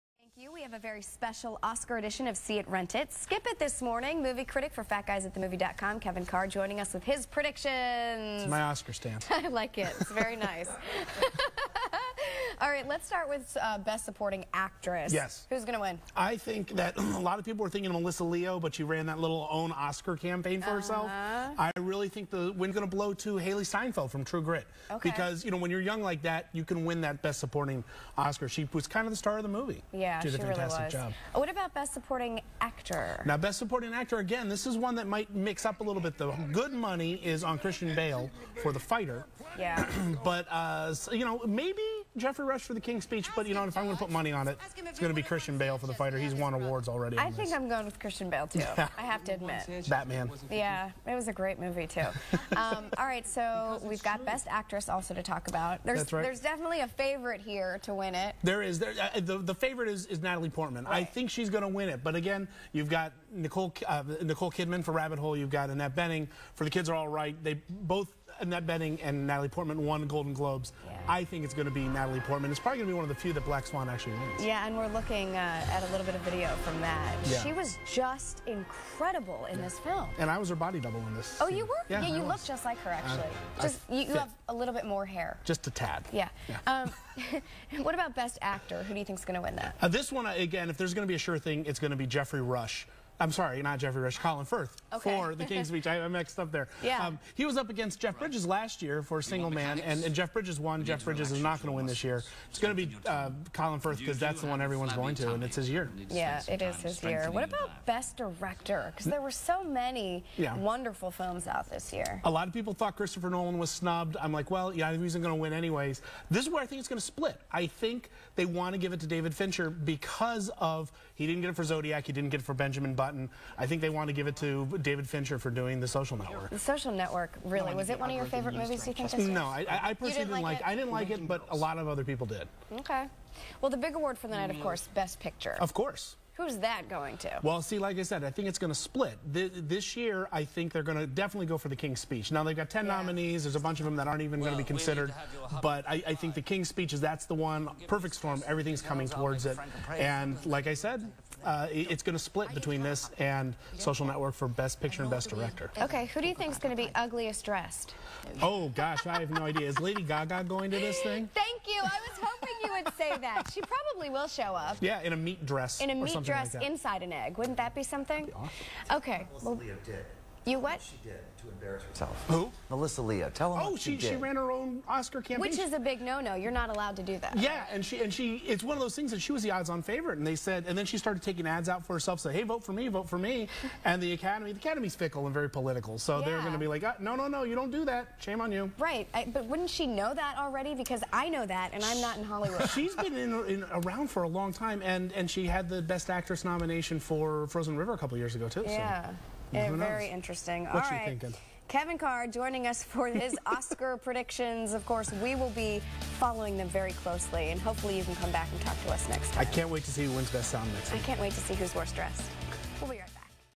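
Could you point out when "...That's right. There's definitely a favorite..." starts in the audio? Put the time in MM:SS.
00:55.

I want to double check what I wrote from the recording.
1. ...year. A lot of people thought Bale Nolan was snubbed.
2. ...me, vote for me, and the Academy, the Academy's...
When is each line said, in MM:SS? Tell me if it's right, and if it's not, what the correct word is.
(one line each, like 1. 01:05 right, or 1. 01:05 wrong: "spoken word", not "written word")
1. 01:51 wrong: "Christopher", not "Bale"
2. 03:02 right.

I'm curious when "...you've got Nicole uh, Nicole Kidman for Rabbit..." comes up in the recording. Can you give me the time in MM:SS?
01:02.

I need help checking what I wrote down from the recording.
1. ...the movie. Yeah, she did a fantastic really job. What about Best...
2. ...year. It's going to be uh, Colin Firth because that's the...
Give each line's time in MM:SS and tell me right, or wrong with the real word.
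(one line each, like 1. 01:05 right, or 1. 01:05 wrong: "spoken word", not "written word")
1. 00:29 right
2. 01:42 right.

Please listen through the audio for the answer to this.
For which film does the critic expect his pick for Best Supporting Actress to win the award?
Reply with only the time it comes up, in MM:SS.
00:24.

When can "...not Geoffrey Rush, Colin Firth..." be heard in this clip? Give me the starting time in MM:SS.
01:33.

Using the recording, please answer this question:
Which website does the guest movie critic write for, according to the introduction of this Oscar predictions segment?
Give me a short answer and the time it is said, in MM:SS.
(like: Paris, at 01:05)
FatGuysAtTheMovie.com, at 00:04.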